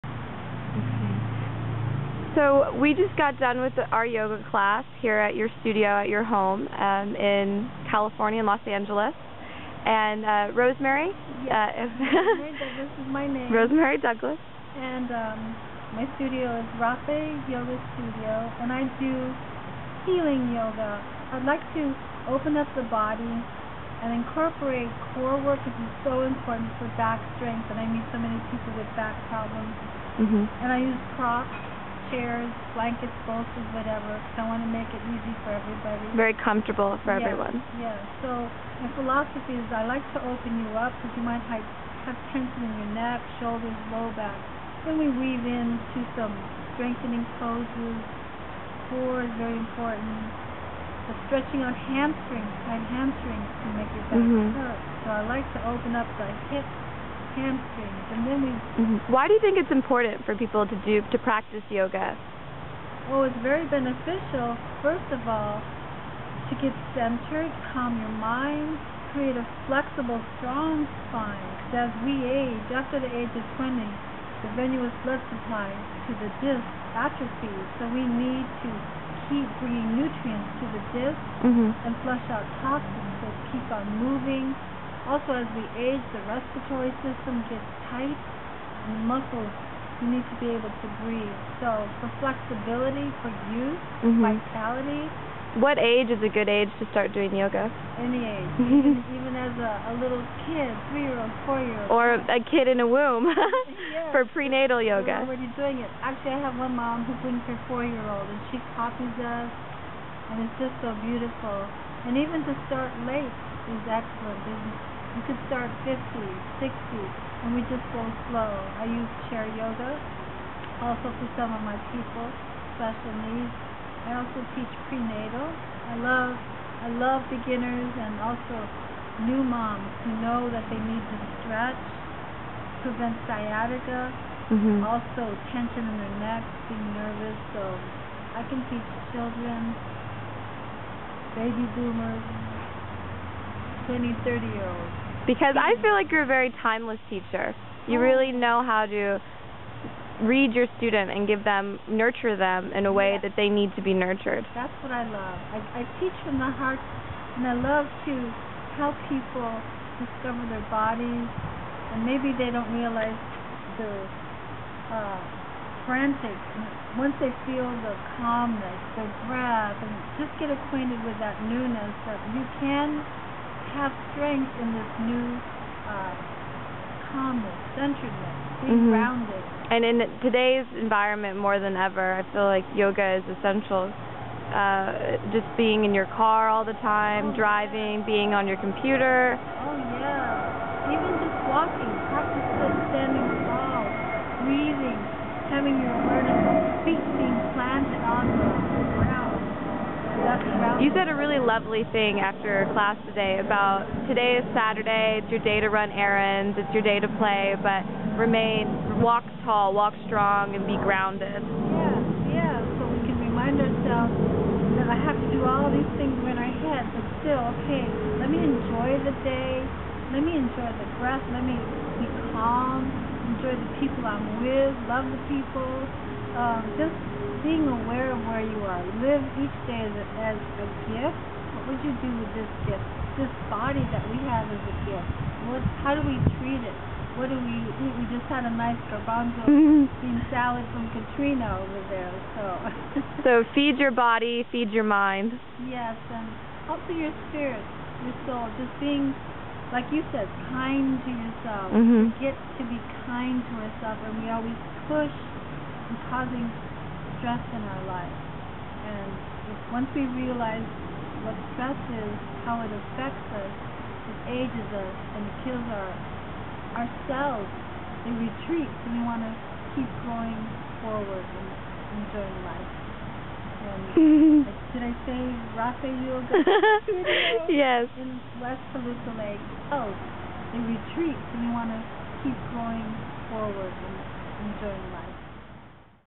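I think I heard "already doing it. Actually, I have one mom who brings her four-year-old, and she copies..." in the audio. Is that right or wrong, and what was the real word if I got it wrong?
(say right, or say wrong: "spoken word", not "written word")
right.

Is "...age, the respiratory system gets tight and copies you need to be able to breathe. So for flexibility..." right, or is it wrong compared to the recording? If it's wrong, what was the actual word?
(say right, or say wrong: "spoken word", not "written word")
wrong: "muscles", not "copies".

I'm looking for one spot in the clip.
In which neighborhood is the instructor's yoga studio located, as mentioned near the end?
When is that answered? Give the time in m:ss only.
4:38.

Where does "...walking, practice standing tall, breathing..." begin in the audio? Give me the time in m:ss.
3:11.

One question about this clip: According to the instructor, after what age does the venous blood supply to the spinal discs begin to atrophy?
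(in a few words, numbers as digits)
20.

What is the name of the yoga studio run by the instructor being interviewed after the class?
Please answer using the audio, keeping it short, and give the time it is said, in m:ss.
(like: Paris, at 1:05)
Raphey Yoga Studio, at 0:16.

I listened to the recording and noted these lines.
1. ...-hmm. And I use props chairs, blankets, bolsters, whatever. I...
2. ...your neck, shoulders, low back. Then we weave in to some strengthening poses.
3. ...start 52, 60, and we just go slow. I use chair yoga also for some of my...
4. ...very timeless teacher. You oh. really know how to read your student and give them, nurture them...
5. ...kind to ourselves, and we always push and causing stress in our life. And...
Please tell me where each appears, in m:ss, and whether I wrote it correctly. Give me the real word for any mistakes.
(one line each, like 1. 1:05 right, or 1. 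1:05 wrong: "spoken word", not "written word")
1. 0:30 right
2. 0:42 right
3. 1:55 wrong: "50", not "52"
4. 2:26 right
5. 4:13 right.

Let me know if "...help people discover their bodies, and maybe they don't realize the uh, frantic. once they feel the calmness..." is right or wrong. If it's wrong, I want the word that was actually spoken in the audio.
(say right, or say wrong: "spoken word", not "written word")
right.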